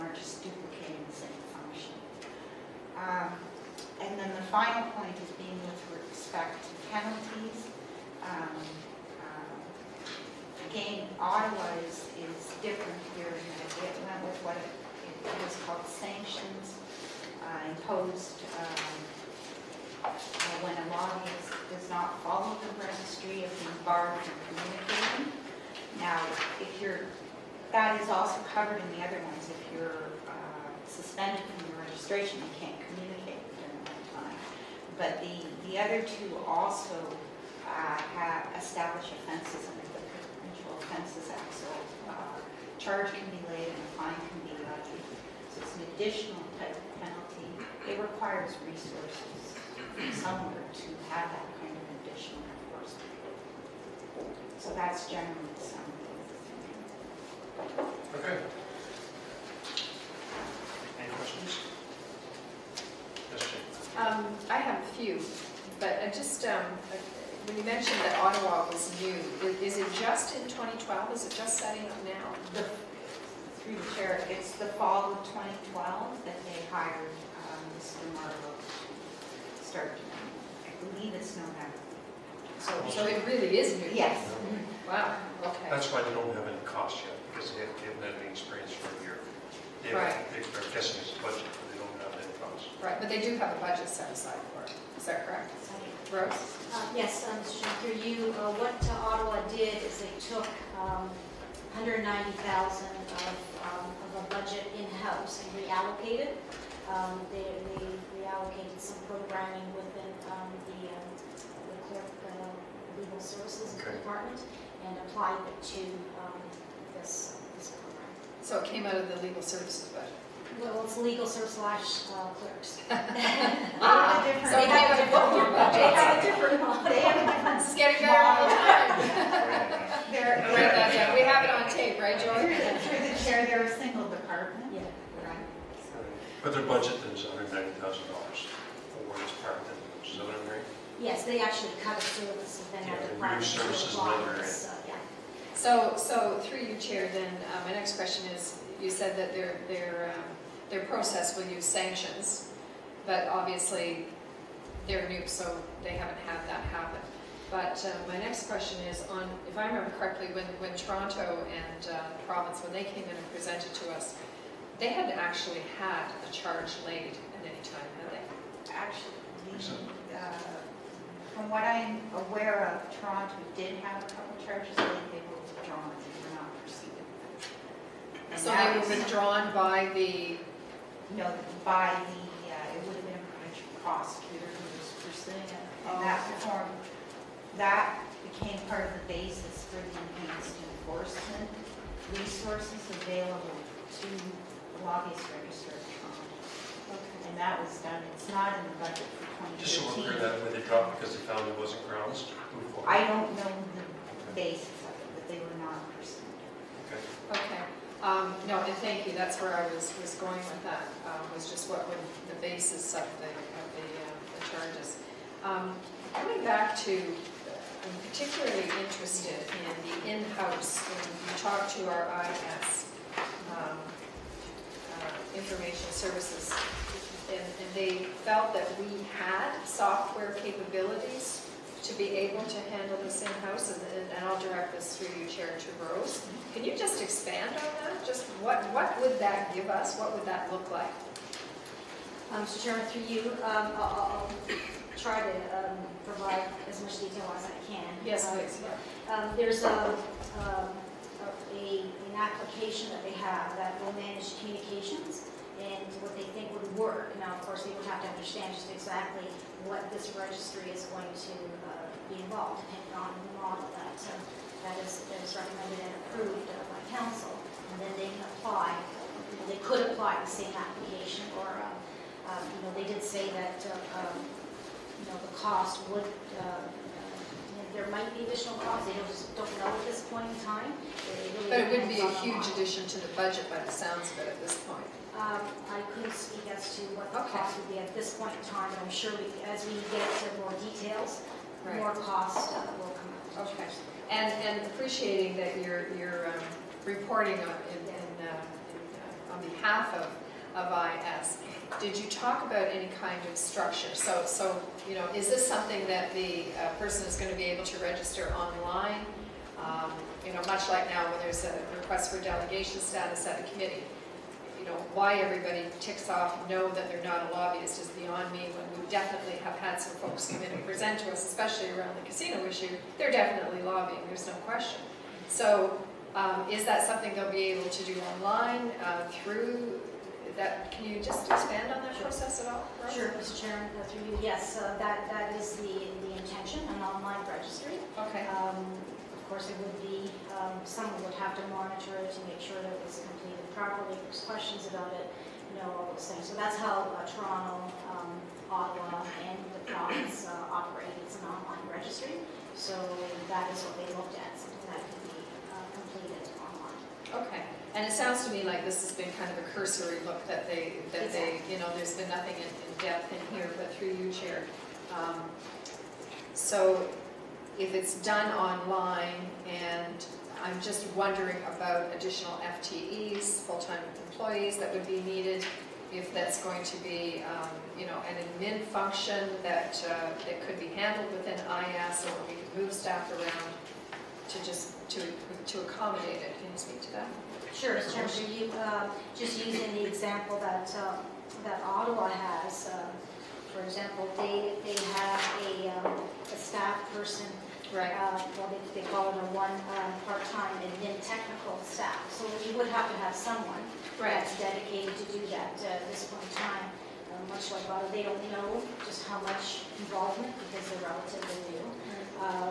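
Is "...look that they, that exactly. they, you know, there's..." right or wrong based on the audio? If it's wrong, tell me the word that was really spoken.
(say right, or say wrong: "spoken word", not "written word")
right.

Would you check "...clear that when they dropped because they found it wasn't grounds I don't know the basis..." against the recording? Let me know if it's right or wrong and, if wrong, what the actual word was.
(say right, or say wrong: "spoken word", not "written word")
right.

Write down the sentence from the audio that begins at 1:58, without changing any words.
So it came out of the legal services budget?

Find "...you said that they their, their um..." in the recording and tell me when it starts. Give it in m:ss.
2:28.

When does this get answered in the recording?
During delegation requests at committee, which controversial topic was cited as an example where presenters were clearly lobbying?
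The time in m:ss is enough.
5:22.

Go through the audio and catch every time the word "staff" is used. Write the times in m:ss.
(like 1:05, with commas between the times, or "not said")
6:22, 6:36, 6:41.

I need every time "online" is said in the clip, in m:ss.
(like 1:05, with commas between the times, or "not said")
5:08, 5:28, 5:36, 5:51, 5:56, 6:08.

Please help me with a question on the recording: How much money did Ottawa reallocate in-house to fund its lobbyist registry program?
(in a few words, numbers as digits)
190,000.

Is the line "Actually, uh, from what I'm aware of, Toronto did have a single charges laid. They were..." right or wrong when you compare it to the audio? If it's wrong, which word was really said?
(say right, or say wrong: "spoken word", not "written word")
wrong: "couple", not "single".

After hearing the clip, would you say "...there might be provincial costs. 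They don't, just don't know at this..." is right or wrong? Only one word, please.
wrong.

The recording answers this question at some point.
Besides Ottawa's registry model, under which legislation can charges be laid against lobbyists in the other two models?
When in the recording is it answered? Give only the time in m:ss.
0:40.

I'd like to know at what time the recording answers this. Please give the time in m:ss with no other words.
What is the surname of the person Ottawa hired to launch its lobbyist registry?
1:18.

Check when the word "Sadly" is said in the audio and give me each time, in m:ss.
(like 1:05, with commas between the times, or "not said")
not said.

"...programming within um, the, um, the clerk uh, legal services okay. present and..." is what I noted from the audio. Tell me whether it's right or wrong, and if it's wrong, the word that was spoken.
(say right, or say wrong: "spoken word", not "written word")
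wrong: "department", not "present".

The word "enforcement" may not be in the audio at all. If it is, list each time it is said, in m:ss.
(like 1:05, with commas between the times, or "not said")
0:52, 3:10.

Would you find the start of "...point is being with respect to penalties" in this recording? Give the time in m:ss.
0:04.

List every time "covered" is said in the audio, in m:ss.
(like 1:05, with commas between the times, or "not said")
0:28.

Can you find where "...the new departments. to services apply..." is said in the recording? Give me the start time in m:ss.
2:23.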